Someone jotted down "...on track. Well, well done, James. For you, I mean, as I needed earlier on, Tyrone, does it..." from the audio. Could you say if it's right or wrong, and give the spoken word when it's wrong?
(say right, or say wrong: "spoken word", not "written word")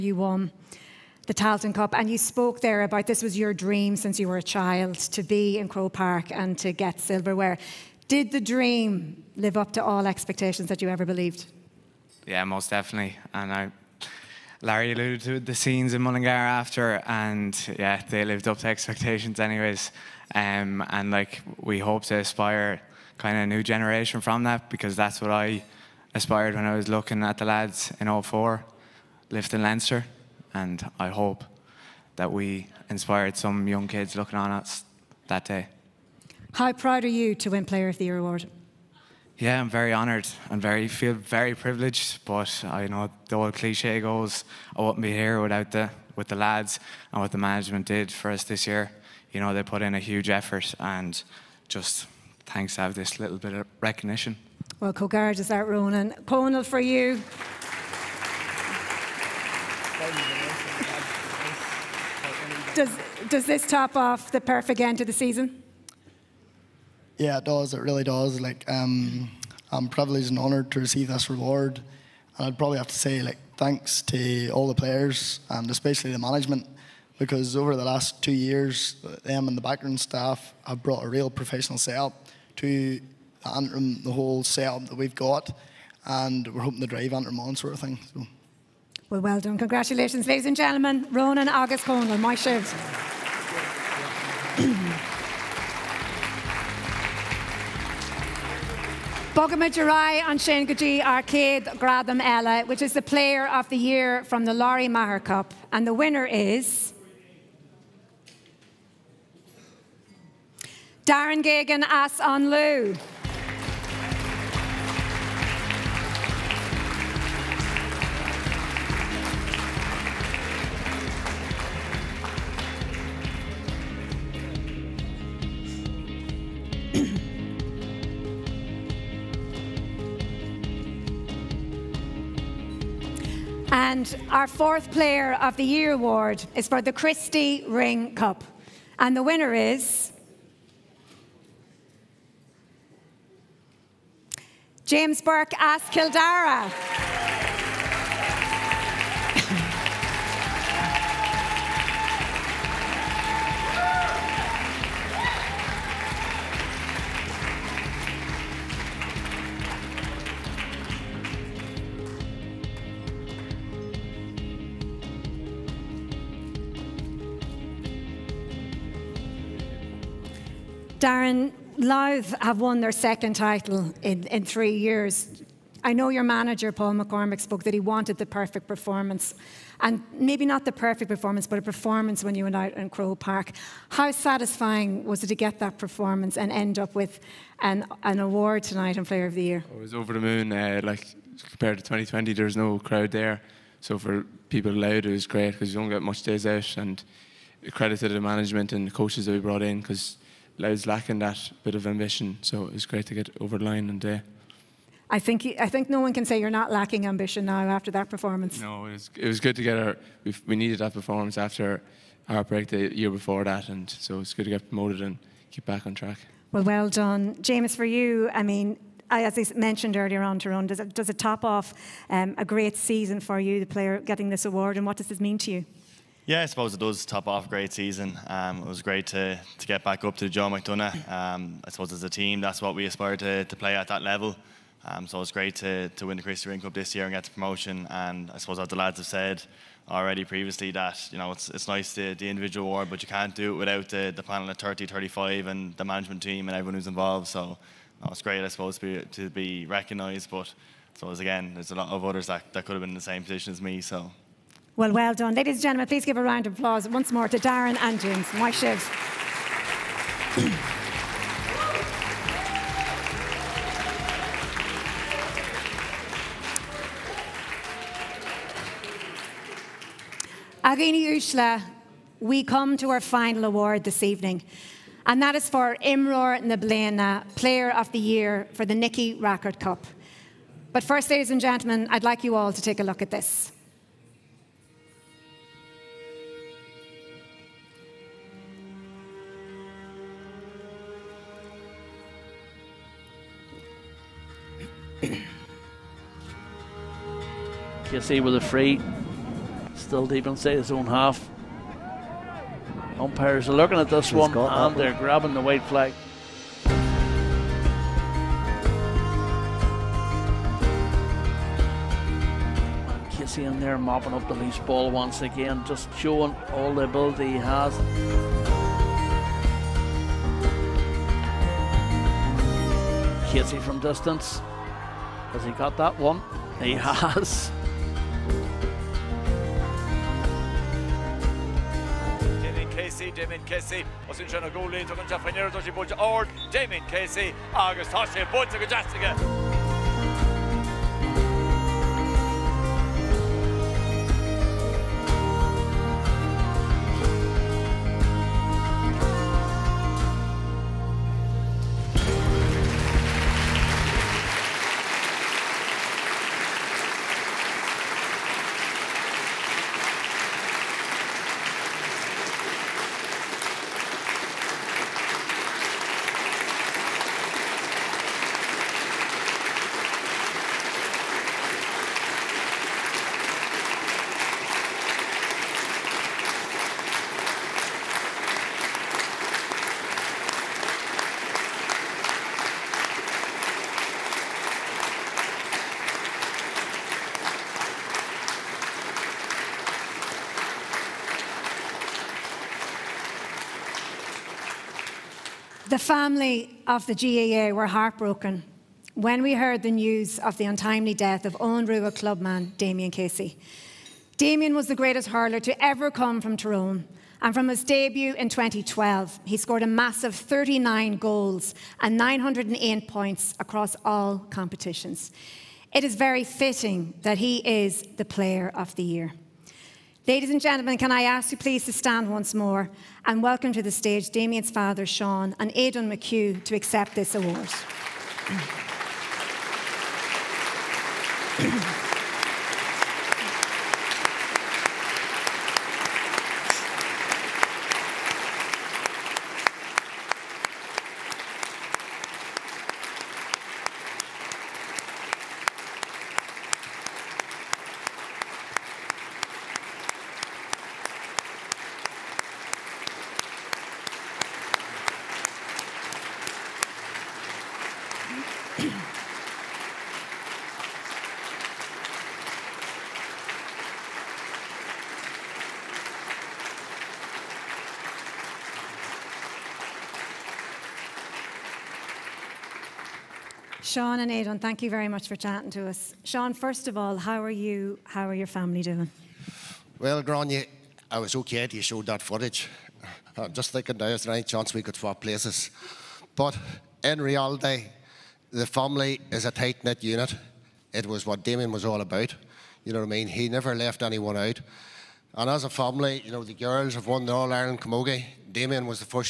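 wrong: "mentioned", not "needed".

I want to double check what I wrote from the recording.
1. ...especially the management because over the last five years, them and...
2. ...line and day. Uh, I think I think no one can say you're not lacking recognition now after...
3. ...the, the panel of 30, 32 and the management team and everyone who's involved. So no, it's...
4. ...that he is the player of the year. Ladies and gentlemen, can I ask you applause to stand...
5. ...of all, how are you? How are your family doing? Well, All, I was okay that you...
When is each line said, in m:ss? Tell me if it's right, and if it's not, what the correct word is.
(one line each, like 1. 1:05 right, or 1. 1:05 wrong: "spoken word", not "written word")
1. 1:15 wrong: "two", not "five"
2. 3:23 wrong: "ambition", not "recognition"
3. 4:03 wrong: "35", not "32"
4. 6:57 wrong: "please", not "applause"
5. 7:56 wrong: "Grania", not "All".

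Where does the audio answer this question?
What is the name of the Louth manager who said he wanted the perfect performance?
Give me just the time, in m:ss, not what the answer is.
2:56.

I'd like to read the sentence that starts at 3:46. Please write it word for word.
Yeah, I suppose it does top off a great season.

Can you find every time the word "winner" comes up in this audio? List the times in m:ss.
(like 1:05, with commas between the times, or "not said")
1:45, 2:19.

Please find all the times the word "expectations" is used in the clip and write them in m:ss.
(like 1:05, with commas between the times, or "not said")
0:10, 0:18.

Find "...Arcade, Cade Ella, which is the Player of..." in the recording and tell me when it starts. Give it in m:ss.
1:41.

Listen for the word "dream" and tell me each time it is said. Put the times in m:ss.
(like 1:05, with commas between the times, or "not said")
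0:03, 0:08.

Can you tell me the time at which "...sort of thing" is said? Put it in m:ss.
1:27.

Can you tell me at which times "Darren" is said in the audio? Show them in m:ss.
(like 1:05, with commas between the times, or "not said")
1:51, 2:50, 4:17.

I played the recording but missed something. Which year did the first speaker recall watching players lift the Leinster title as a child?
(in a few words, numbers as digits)
2004.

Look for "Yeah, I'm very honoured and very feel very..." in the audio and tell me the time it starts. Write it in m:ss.
0:39.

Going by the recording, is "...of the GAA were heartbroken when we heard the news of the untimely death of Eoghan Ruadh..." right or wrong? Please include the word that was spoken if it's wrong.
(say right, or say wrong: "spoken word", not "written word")
right.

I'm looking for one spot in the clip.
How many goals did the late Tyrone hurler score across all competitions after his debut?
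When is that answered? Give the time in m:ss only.
6:50.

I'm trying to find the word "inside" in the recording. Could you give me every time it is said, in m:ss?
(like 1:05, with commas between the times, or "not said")
5:00.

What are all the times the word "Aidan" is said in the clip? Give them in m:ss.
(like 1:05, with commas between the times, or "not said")
7:05, 7:54.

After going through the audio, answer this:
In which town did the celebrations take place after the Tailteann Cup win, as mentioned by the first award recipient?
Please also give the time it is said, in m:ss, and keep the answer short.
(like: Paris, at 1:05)
Mullingar, at 0:16.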